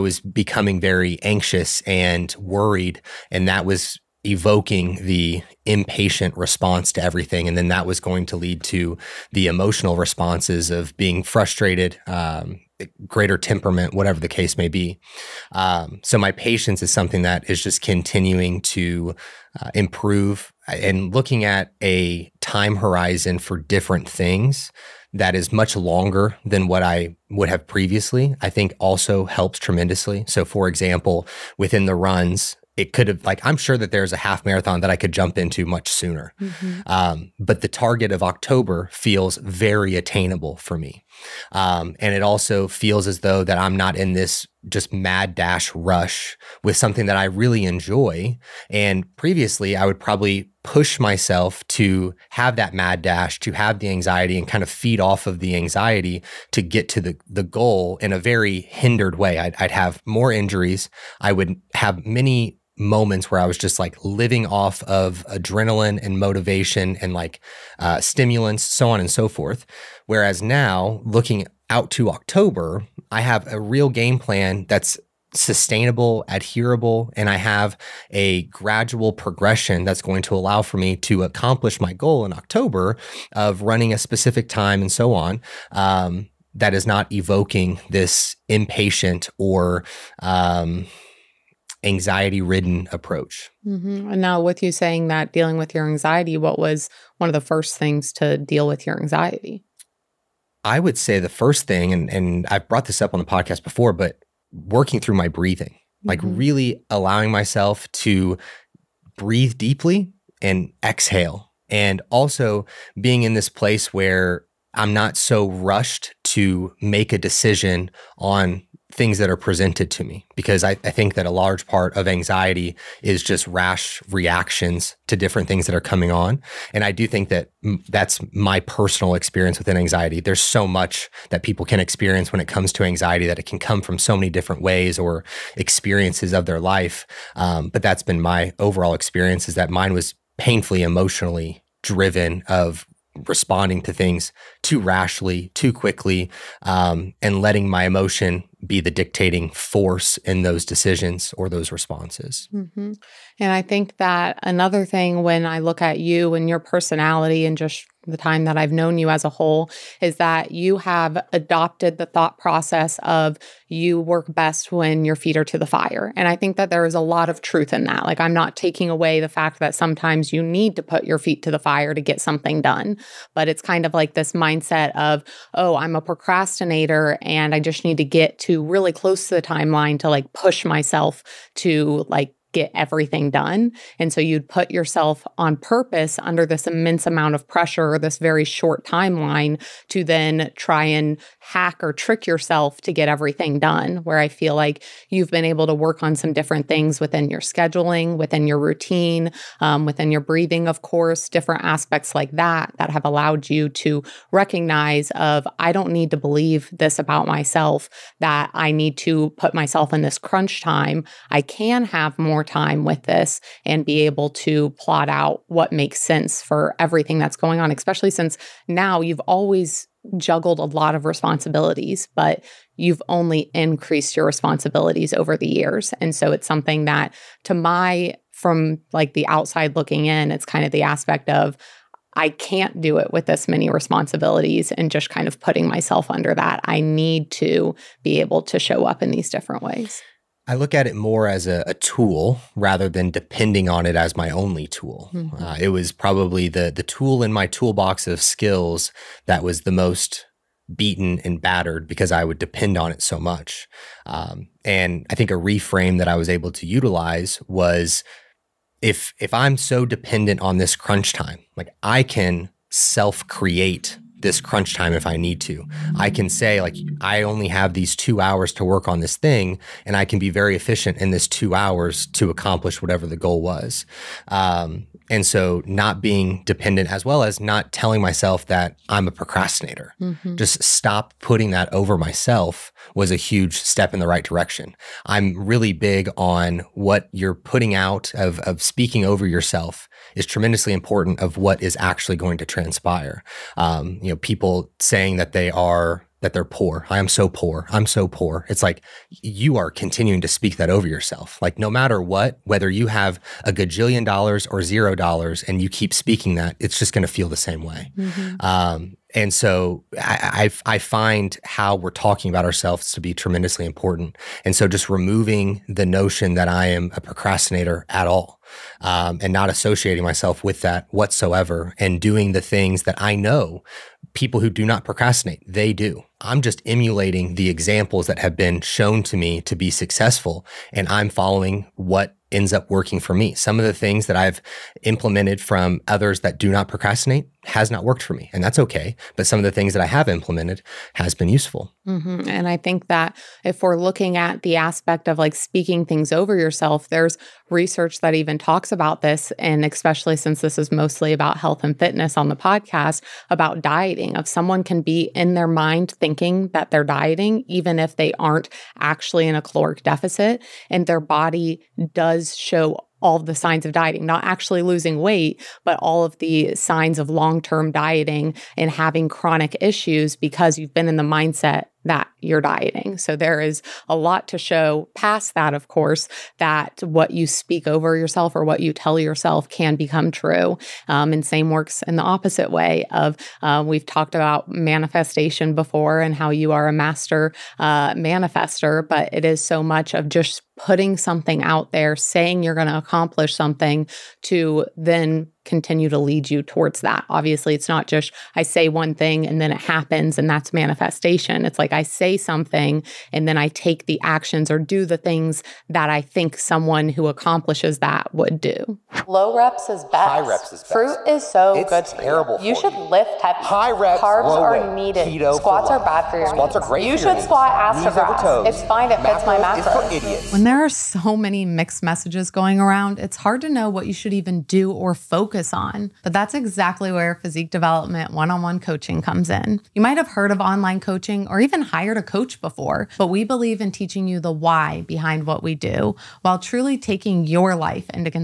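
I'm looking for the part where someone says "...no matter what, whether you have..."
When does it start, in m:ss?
5:01.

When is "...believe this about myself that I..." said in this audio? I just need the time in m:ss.
3:26.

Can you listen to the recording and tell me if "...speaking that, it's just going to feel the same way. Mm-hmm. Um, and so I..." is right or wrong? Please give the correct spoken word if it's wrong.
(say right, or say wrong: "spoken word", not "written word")
right.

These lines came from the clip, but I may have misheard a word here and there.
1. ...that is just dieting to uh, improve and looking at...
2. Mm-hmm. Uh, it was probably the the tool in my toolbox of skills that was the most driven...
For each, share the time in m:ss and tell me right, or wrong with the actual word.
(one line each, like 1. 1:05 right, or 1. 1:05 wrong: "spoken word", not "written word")
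1. 0:17 wrong: "continuing", not "dieting"
2. 4:05 wrong: "beaten", not "driven".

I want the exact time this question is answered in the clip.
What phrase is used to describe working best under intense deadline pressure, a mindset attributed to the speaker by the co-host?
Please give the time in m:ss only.
2:45.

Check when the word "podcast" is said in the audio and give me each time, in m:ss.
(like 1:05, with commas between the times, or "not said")
1:43, 5:52.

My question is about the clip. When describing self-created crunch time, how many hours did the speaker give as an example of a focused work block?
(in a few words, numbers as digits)
2 hours.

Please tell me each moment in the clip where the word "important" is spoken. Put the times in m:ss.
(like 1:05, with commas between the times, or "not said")
4:50, 5:13.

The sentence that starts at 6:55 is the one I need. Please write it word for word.
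Keto Squats are bad for your Squats needs.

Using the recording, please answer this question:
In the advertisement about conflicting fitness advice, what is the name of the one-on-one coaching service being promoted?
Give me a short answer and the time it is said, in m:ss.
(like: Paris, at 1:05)
Physique Development, at 7:07.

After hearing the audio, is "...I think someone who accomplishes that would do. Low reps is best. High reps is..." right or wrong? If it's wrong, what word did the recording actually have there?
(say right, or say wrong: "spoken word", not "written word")
right.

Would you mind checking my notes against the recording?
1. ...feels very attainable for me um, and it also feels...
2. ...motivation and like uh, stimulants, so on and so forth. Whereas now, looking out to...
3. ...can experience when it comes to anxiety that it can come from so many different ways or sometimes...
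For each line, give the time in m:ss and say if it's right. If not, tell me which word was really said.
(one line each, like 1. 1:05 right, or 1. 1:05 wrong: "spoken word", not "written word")
1. 0:38 right
2. 1:06 right
3. 2:11 wrong: "experiences", not "sometimes".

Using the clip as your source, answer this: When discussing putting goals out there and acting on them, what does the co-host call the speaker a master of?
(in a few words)
Manifester.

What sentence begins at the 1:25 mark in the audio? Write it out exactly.
Um, that is not evoking this impatient or um, anxiety ridden approach.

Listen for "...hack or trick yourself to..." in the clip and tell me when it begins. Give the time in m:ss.
3:11.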